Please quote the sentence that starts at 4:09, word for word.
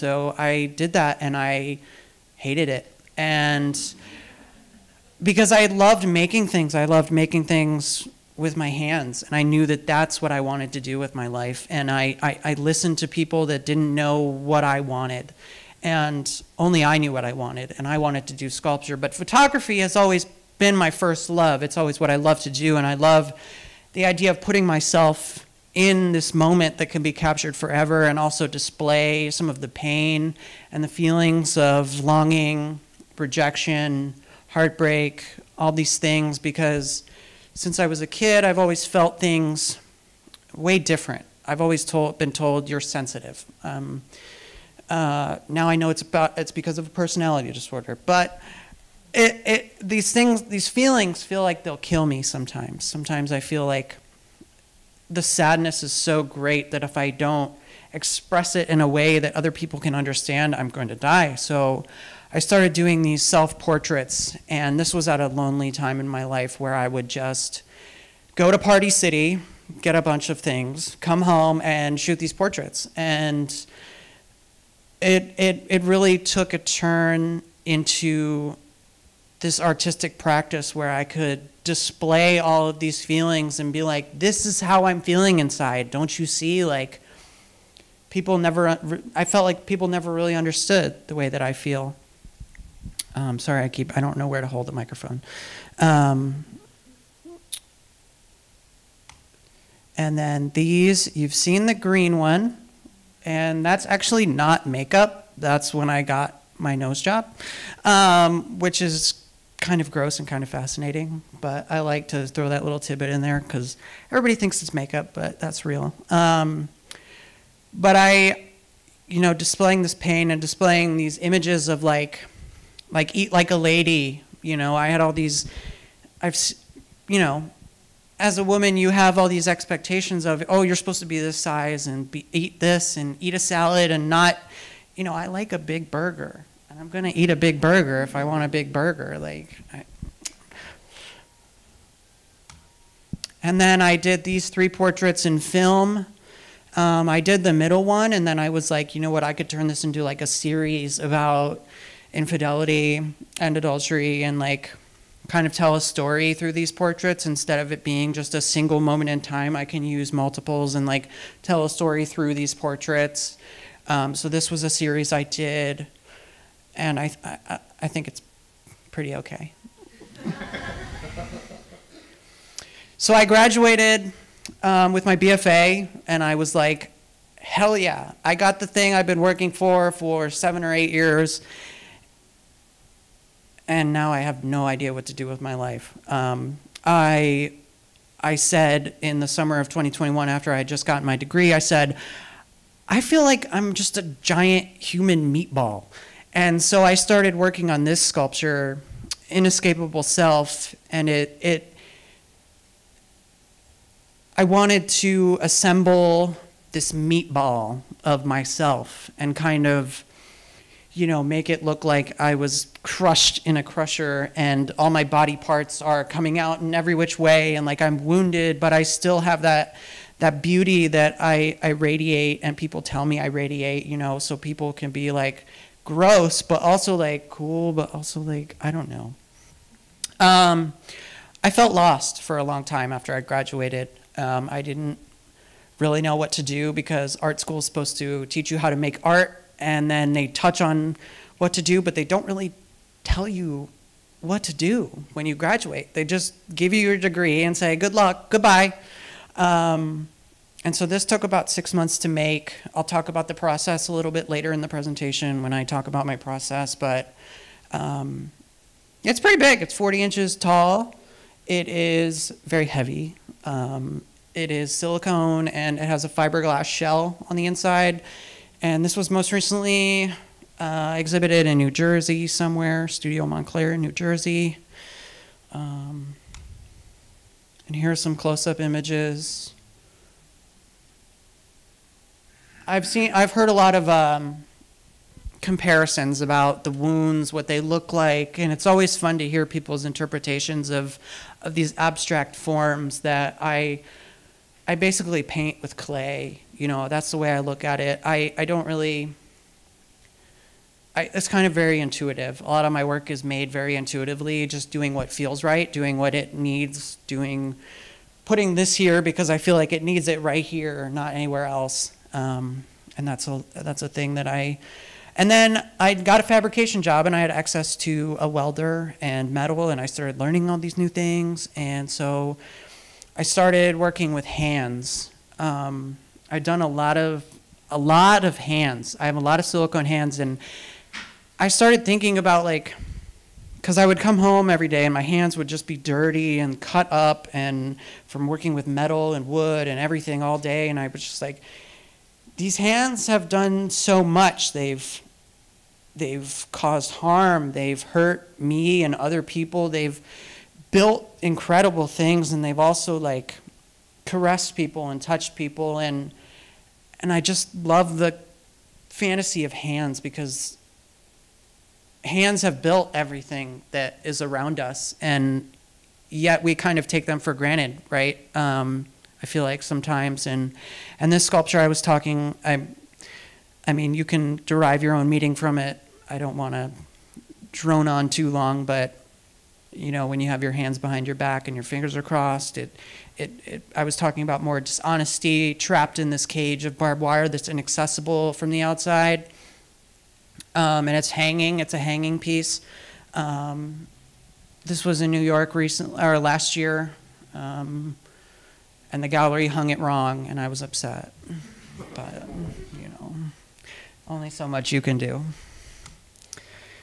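Um, and so this took about six months to make.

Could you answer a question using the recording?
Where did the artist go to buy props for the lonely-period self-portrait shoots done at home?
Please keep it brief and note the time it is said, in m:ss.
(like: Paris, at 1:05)
Party City, at 1:08.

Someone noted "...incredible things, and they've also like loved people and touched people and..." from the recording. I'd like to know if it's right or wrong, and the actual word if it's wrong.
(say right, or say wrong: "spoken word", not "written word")
wrong: "caressed", not "loved".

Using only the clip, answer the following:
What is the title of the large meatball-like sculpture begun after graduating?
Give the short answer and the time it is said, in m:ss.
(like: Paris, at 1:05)
Inescapable Self, at 3:19.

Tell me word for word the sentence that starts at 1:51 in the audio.
But I like to throw that little tidbit in there because everybody thinks it's makeup, but that's real.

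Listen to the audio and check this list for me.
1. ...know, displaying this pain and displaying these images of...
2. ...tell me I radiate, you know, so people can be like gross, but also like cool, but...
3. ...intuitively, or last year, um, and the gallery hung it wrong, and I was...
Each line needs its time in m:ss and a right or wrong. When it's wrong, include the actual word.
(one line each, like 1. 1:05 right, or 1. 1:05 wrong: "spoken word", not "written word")
1. 1:59 right
2. 3:42 right
3. 6:35 wrong: "recently", not "intuitively".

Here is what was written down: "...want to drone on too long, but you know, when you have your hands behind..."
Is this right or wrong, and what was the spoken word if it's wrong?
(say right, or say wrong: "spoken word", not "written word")
right.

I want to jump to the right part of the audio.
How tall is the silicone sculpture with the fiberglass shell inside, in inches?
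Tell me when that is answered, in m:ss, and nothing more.
4:19.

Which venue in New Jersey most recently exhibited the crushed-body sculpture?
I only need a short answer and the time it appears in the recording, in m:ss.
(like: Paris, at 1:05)
Studio Montclair, at 4:32.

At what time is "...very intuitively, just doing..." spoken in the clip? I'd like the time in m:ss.
5:03.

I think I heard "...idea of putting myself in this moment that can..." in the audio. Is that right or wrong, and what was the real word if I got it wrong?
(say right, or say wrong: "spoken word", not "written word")
right.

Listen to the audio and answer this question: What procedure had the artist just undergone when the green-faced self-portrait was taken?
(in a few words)
Nose job.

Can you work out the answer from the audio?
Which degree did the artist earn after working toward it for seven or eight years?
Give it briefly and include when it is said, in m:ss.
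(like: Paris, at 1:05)
BFA, at 2:55.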